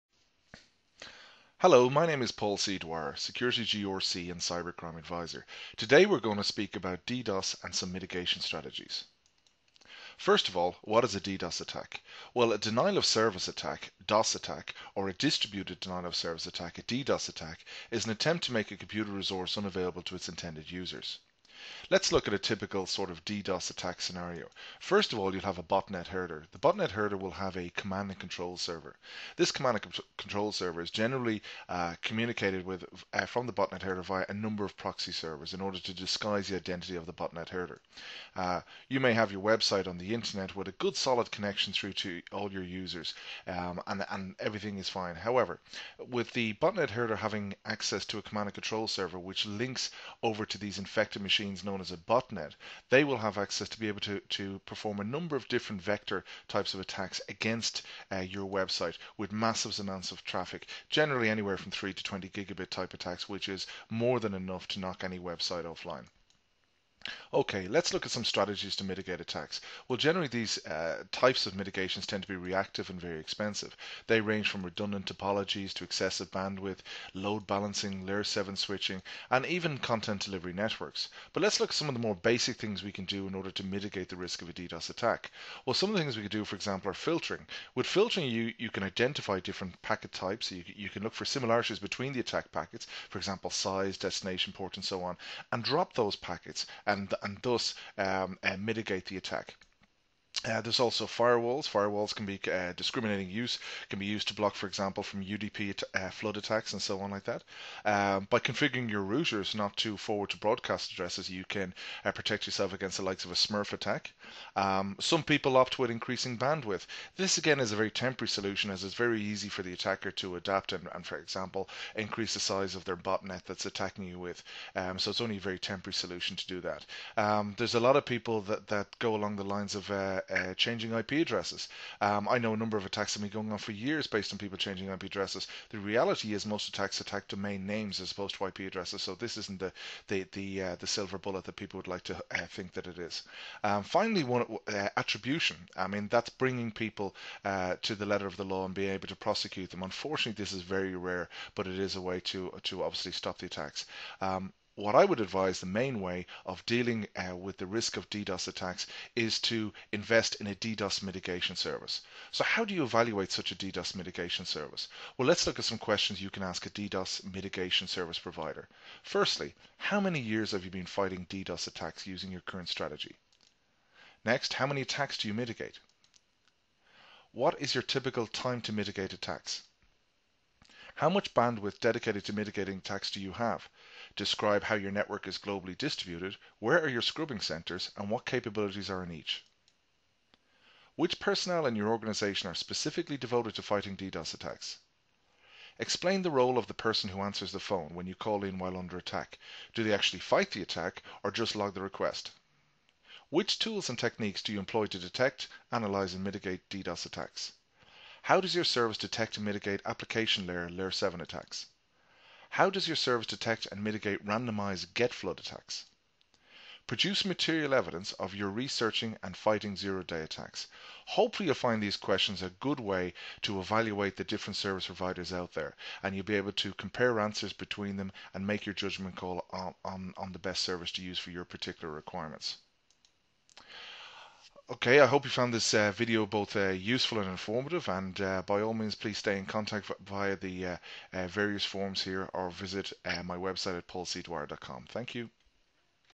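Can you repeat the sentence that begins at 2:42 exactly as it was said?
So, how do you evaluate such a DDoS mitigation service?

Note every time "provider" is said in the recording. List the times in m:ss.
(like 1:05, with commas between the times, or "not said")
2:48, 3:44.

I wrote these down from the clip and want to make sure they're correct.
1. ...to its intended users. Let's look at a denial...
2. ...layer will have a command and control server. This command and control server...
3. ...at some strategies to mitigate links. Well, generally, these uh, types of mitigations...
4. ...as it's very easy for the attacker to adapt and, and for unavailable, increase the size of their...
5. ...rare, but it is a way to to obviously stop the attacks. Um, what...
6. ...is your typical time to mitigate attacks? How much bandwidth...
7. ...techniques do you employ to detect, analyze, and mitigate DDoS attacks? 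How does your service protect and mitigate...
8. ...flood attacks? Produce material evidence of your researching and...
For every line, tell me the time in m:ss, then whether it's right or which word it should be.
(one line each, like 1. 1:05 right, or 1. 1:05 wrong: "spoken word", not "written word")
1. 0:20 wrong: "typical", not "denial"
2. 0:26 wrong: "herder", not "layer"
3. 1:08 wrong: "attacks", not "links"
4. 1:58 wrong: "example", not "unavailable"
5. 2:30 right
6. 2:57 right
7. 3:23 wrong: "detect", not "protect"
8. 3:35 right.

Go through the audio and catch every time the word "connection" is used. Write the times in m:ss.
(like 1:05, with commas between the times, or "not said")
0:41.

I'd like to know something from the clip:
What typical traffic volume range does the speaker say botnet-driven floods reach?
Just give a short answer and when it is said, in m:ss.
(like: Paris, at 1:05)
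3 to 20 gigabit, at 1:01.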